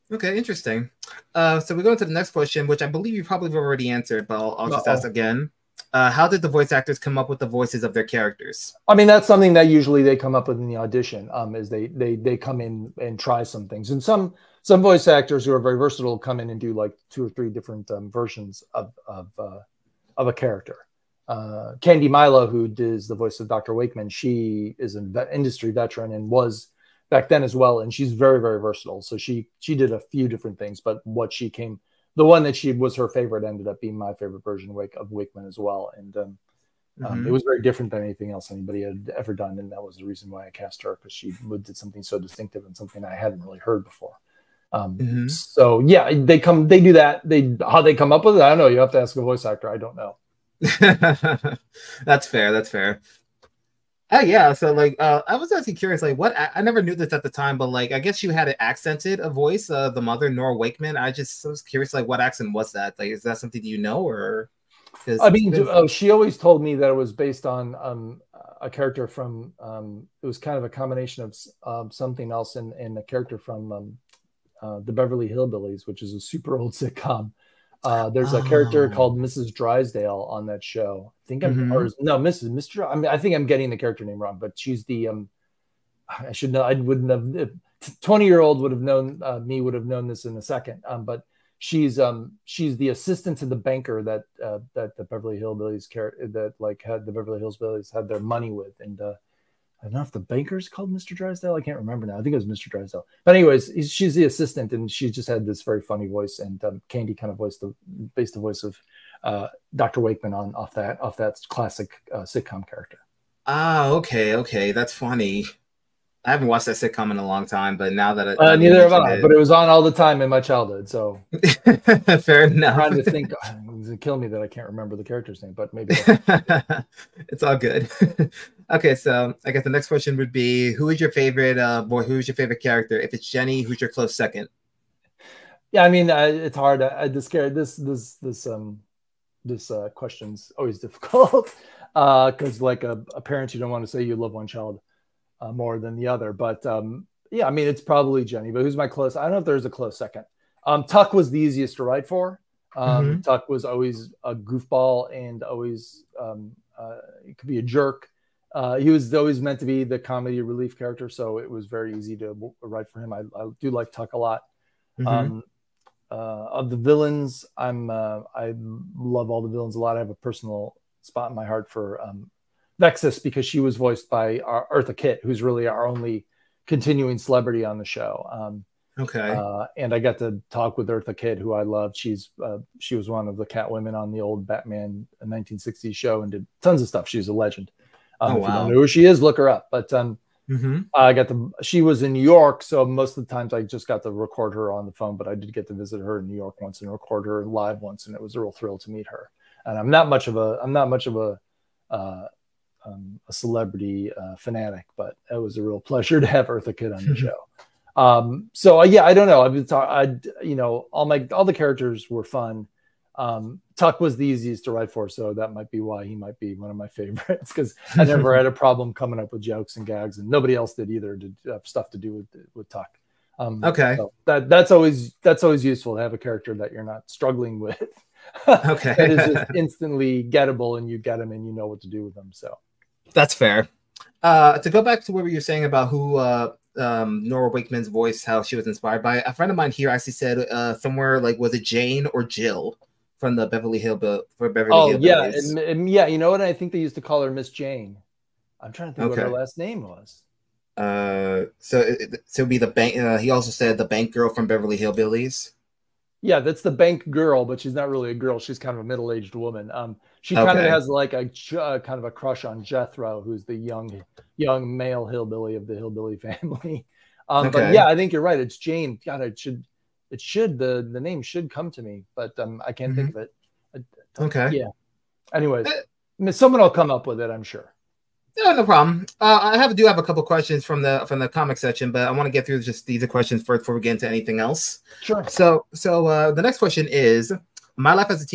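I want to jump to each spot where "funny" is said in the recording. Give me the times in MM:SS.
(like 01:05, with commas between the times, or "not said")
01:45, 01:54.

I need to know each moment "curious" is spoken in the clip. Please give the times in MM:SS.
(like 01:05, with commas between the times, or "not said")
00:55, 01:01.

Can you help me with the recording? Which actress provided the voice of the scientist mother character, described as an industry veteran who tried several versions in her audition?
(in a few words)
Candy Milo.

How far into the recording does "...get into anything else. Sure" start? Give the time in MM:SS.
04:43.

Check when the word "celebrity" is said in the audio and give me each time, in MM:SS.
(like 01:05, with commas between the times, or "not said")
02:57, 03:23.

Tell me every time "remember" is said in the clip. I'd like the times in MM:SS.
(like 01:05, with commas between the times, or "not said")
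01:41, 02:04.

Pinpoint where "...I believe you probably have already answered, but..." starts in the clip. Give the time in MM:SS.
00:02.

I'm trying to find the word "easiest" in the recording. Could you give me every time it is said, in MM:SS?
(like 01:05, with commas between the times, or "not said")
02:31, 03:34.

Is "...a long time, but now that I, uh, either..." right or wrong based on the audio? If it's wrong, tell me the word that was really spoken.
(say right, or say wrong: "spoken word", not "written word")
wrong: "neither", not "either".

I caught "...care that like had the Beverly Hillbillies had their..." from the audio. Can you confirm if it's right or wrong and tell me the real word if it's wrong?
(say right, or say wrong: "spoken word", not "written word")
right.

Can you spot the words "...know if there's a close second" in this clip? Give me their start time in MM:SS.
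02:29.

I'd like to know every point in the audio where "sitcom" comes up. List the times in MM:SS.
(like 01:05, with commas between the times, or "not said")
01:16, 01:52, 01:56.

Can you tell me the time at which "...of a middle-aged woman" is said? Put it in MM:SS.
04:18.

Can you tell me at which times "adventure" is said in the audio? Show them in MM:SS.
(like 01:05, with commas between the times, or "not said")
not said.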